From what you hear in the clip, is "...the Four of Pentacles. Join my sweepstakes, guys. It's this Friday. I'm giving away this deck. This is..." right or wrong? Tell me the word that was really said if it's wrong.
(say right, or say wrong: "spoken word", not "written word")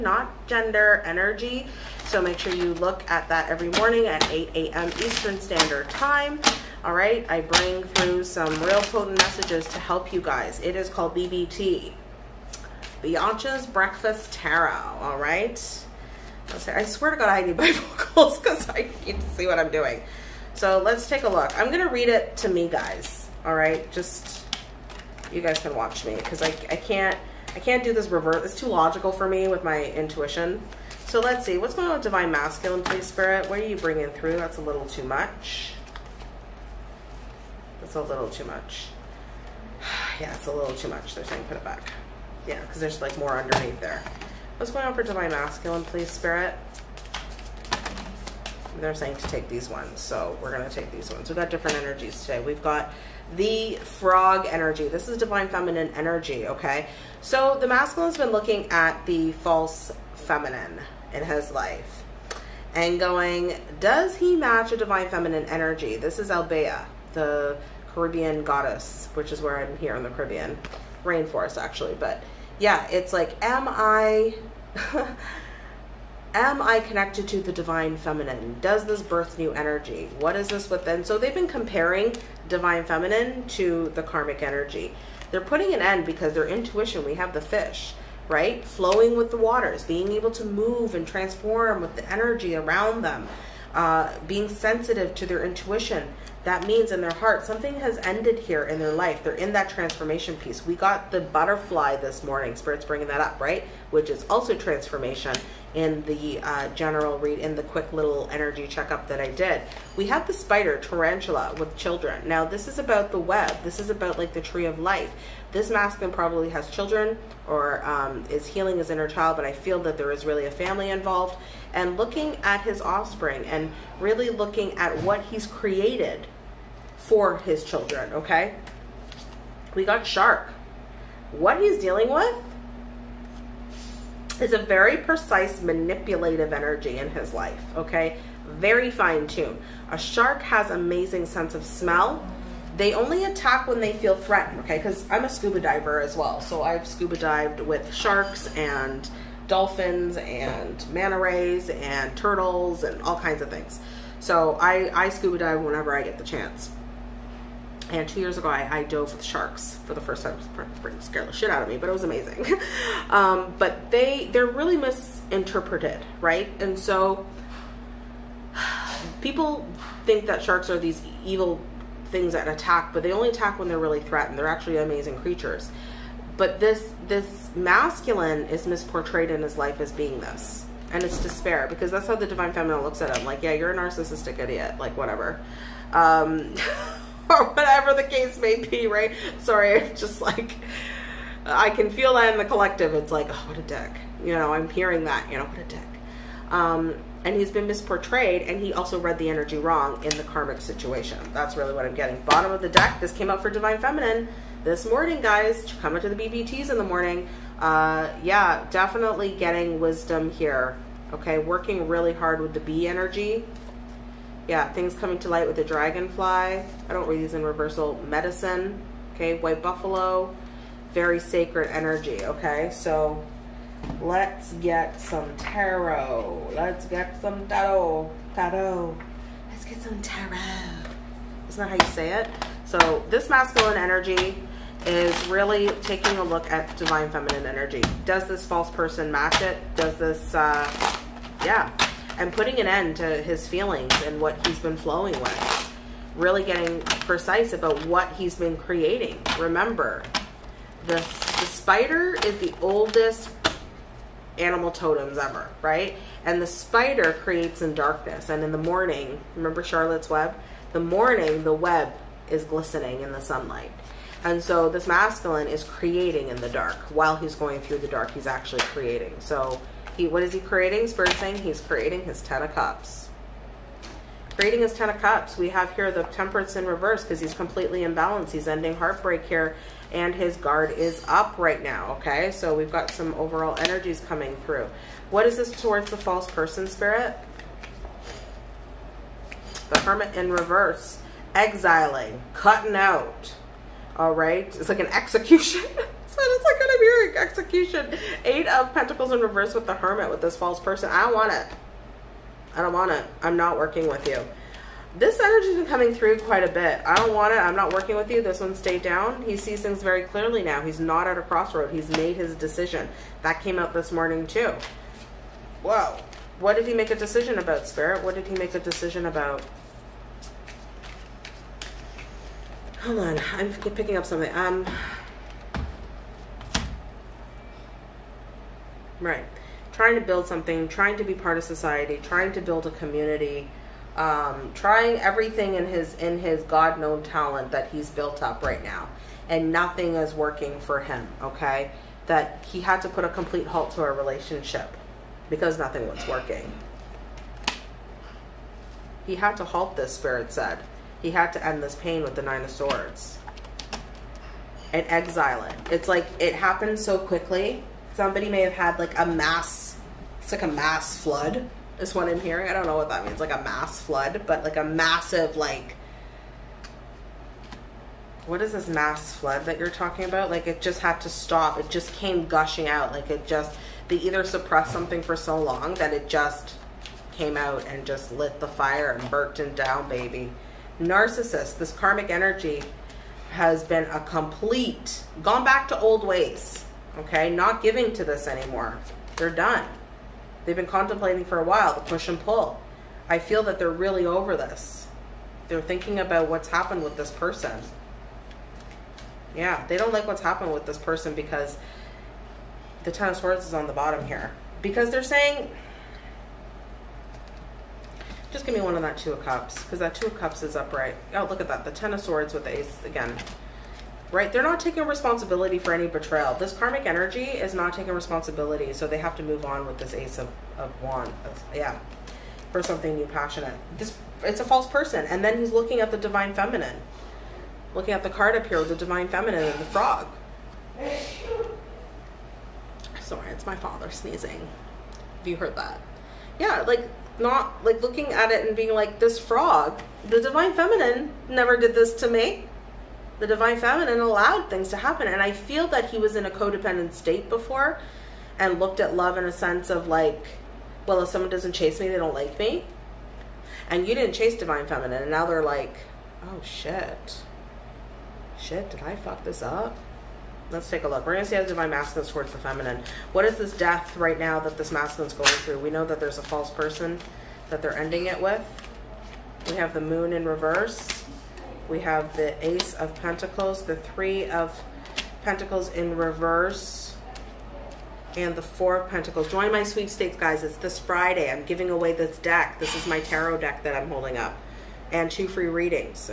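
right.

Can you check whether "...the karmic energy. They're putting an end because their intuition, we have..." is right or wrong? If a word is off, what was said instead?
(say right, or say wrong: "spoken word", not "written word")
right.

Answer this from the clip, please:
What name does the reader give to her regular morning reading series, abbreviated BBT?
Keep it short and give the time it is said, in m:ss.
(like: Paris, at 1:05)
Bianca's Breakfast Tarot, at 0:13.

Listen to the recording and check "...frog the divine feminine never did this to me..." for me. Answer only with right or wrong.
right.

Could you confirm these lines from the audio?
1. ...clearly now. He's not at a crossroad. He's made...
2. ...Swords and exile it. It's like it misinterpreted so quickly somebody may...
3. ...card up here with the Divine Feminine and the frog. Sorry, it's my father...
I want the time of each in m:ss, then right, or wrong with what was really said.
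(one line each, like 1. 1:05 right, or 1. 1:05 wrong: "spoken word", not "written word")
1. 5:10 right
2. 5:52 wrong: "happened", not "misinterpreted"
3. 7:08 right.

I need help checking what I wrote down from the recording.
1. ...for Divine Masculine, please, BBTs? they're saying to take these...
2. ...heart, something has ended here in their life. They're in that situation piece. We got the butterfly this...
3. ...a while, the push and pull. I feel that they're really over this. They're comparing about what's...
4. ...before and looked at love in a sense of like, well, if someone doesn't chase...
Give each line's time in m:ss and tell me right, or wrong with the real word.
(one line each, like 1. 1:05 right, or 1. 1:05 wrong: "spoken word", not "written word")
1. 0:44 wrong: "Spirit", not "BBTs"
2. 1:37 wrong: "transformation", not "situation"
3. 6:31 wrong: "thinking", not "comparing"
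4. 7:27 right.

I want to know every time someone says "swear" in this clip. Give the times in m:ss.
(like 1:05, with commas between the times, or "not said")
0:16.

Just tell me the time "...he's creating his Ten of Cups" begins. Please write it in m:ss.
4:31.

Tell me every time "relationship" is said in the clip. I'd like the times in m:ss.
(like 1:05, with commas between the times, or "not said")
5:43.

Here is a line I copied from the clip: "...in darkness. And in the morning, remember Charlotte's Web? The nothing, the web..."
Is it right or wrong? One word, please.
wrong.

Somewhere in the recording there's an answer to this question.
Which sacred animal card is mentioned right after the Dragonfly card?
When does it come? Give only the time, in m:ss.
3:39.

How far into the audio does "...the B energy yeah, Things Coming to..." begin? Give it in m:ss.
3:32.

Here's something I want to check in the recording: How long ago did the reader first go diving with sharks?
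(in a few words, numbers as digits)
2 years ago.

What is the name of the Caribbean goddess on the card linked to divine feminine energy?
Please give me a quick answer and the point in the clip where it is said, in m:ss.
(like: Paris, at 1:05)
Albea, at 1:06.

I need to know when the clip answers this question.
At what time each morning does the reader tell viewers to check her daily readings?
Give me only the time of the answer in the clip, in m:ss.
0:04.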